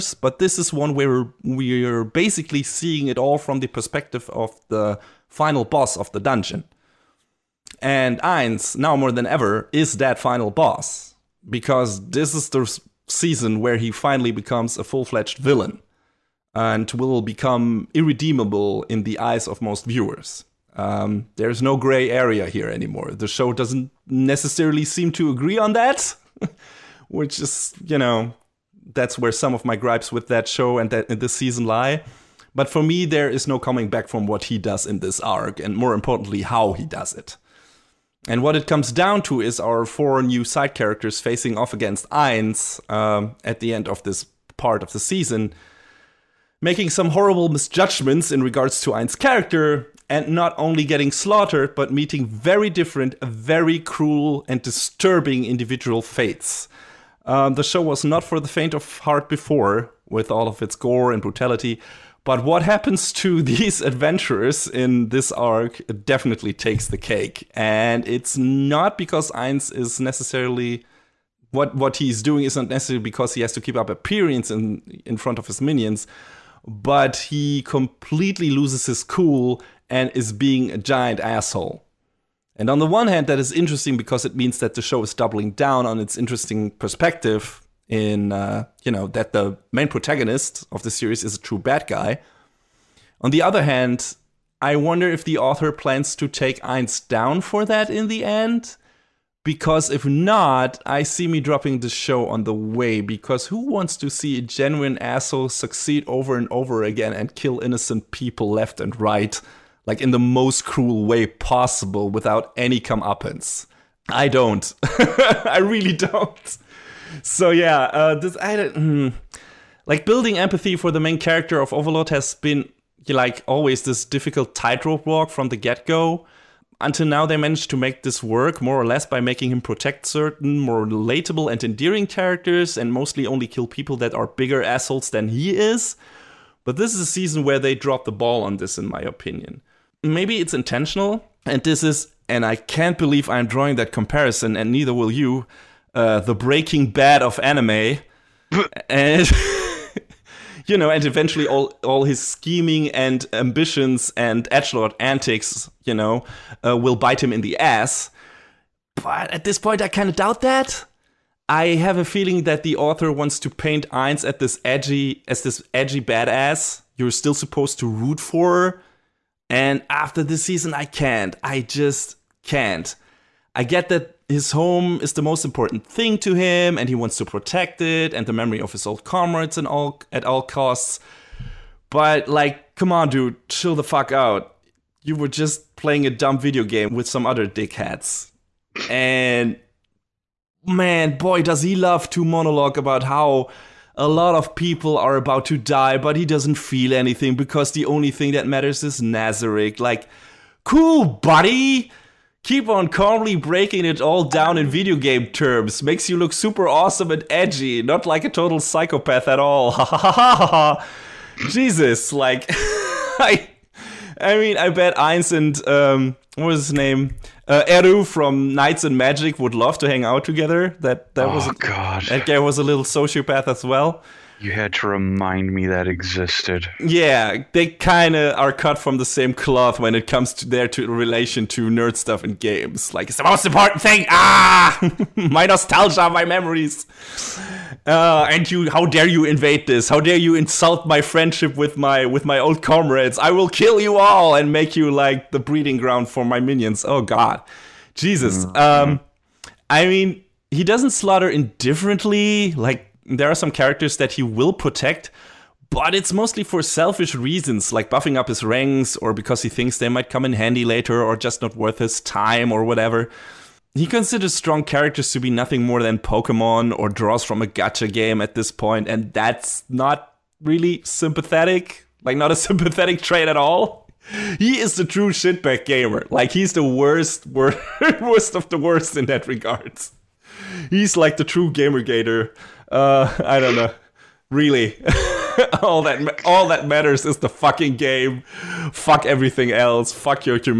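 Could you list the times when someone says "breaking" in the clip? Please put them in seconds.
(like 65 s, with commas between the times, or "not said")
146 s, 203 s.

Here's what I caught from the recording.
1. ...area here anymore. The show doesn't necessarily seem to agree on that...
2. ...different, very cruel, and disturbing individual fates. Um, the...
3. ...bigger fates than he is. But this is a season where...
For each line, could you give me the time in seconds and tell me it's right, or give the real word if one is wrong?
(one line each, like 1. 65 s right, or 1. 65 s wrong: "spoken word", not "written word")
1. 22 s right
2. 52 s right
3. 134 s wrong: "assholes", not "fates".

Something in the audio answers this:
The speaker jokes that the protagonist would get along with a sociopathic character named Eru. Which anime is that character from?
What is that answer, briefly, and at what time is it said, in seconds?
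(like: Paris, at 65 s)
Knights and Magic, at 218 s.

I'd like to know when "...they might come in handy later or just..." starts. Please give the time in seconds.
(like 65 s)
259 s.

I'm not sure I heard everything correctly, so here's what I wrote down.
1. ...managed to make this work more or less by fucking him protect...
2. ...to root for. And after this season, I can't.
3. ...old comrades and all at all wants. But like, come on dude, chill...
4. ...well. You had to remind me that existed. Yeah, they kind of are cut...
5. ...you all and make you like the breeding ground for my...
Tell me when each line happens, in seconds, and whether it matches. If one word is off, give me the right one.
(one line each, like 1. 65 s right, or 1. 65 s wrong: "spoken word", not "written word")
1. 127 s wrong: "making", not "fucking"
2. 167 s right
3. 178 s wrong: "costs", not "wants"
4. 223 s right
5. 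243 s right.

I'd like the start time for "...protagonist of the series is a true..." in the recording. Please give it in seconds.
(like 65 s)
89 s.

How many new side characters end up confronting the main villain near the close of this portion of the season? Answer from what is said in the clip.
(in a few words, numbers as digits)
4.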